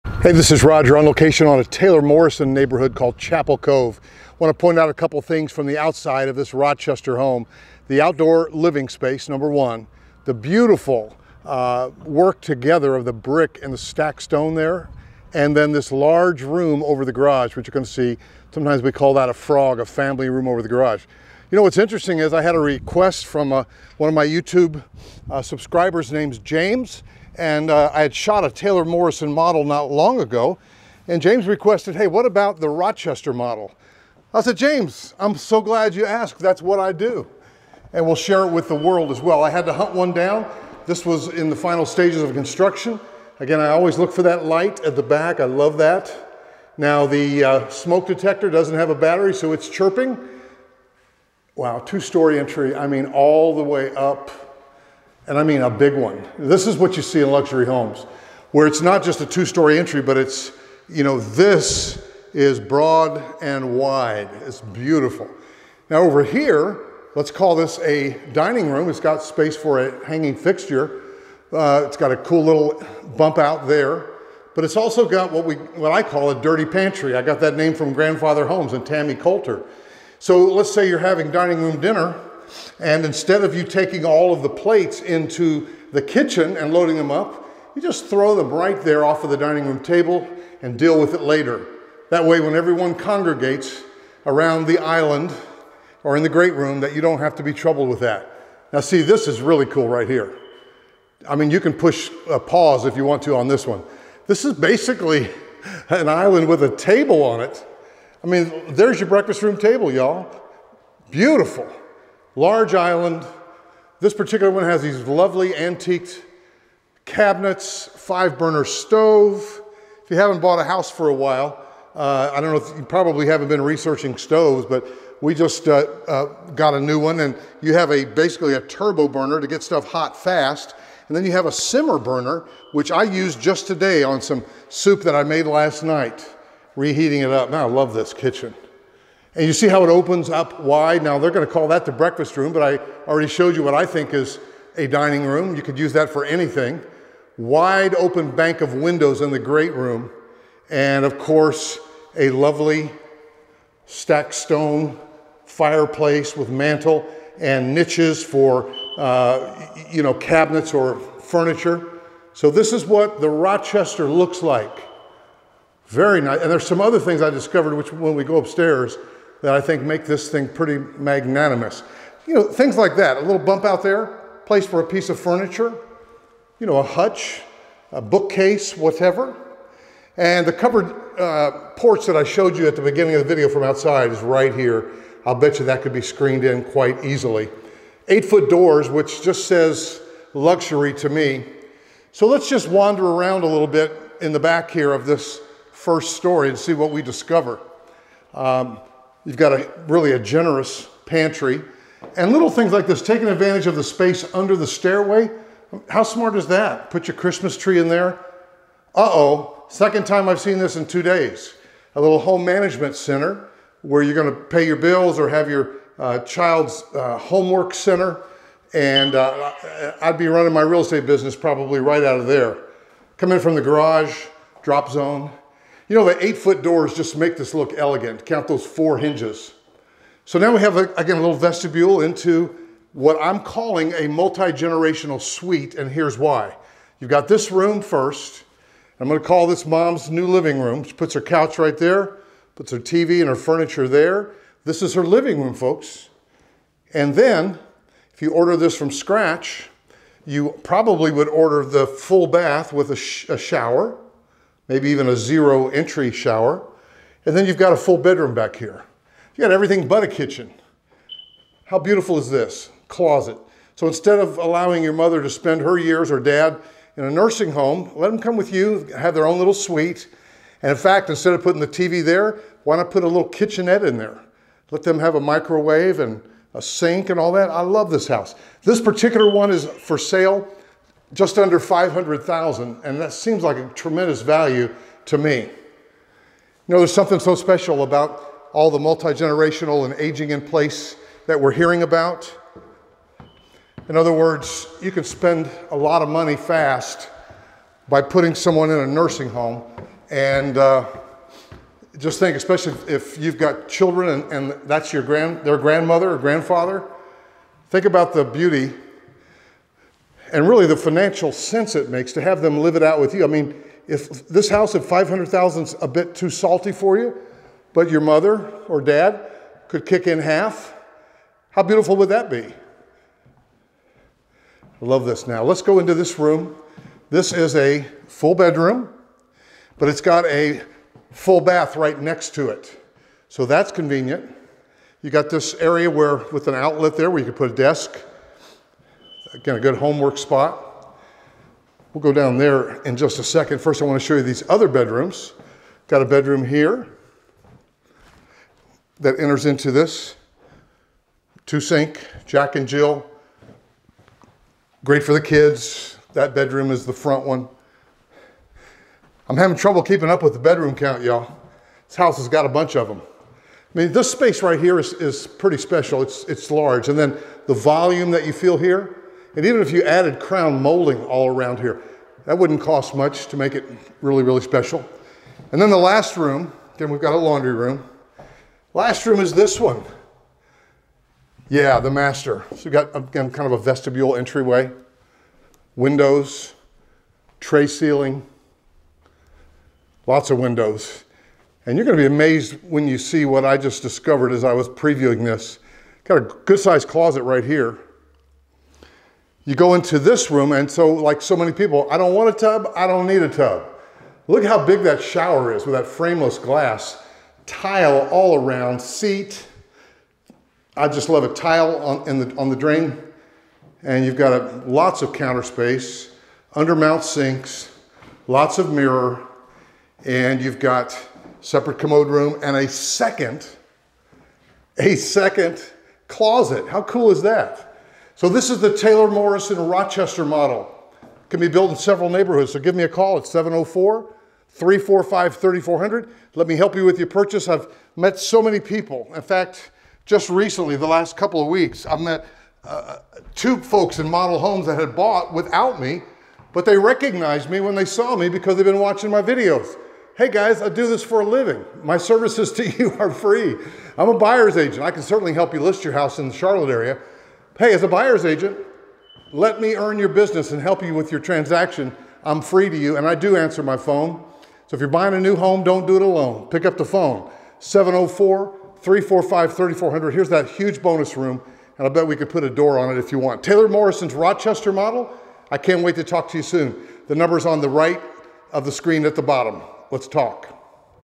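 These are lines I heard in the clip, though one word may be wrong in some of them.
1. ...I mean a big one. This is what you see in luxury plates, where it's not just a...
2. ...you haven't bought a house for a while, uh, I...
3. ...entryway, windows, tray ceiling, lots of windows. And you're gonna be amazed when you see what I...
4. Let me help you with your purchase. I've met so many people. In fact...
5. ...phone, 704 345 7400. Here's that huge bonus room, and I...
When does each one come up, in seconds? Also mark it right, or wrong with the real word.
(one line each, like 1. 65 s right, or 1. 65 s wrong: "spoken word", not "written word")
1. 55 s wrong: "homes", not "plates"
2. 120 s right
3. 384 s right
4. 436 s right
5. 466 s wrong: "3400", not "7400".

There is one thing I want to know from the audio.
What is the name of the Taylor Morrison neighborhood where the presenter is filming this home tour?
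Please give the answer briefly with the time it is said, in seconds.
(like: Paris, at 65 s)
Chapel Cove, at 3 s.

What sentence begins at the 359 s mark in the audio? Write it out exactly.
I'm having trouble keeping up with the bedroom count, y'all.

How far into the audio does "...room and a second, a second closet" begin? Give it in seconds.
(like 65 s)
422 s.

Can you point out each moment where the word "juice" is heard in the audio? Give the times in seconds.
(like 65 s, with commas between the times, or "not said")
not said.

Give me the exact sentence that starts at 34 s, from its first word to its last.
I said, James, I'm so glad you asked.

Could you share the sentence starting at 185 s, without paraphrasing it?
I'll bet you that could be screened in quite easily.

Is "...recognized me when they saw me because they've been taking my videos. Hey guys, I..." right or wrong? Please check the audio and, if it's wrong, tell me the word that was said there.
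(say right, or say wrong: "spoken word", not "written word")
wrong: "watching", not "taking".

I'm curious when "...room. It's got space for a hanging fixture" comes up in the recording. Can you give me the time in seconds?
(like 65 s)
68 s.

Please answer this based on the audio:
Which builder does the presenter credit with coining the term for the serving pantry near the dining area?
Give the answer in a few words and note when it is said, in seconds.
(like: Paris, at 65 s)
Grandfather Homes, at 77 s.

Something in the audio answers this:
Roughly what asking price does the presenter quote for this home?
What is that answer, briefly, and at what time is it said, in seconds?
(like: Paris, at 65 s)
Just under $500,000, at 281 s.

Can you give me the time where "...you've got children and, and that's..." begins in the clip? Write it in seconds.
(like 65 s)
303 s.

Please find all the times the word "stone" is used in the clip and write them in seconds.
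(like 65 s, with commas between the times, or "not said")
14 s, 154 s.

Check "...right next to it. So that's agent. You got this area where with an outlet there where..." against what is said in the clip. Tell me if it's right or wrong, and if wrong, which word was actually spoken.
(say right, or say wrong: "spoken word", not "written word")
wrong: "convenient", not "agent".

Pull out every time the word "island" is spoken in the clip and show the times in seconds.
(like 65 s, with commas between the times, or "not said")
94 s, 106 s, 112 s.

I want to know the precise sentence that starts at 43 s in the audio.
Again, I always look for that light at the back.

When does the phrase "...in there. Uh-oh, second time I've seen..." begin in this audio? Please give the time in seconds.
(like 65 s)
207 s.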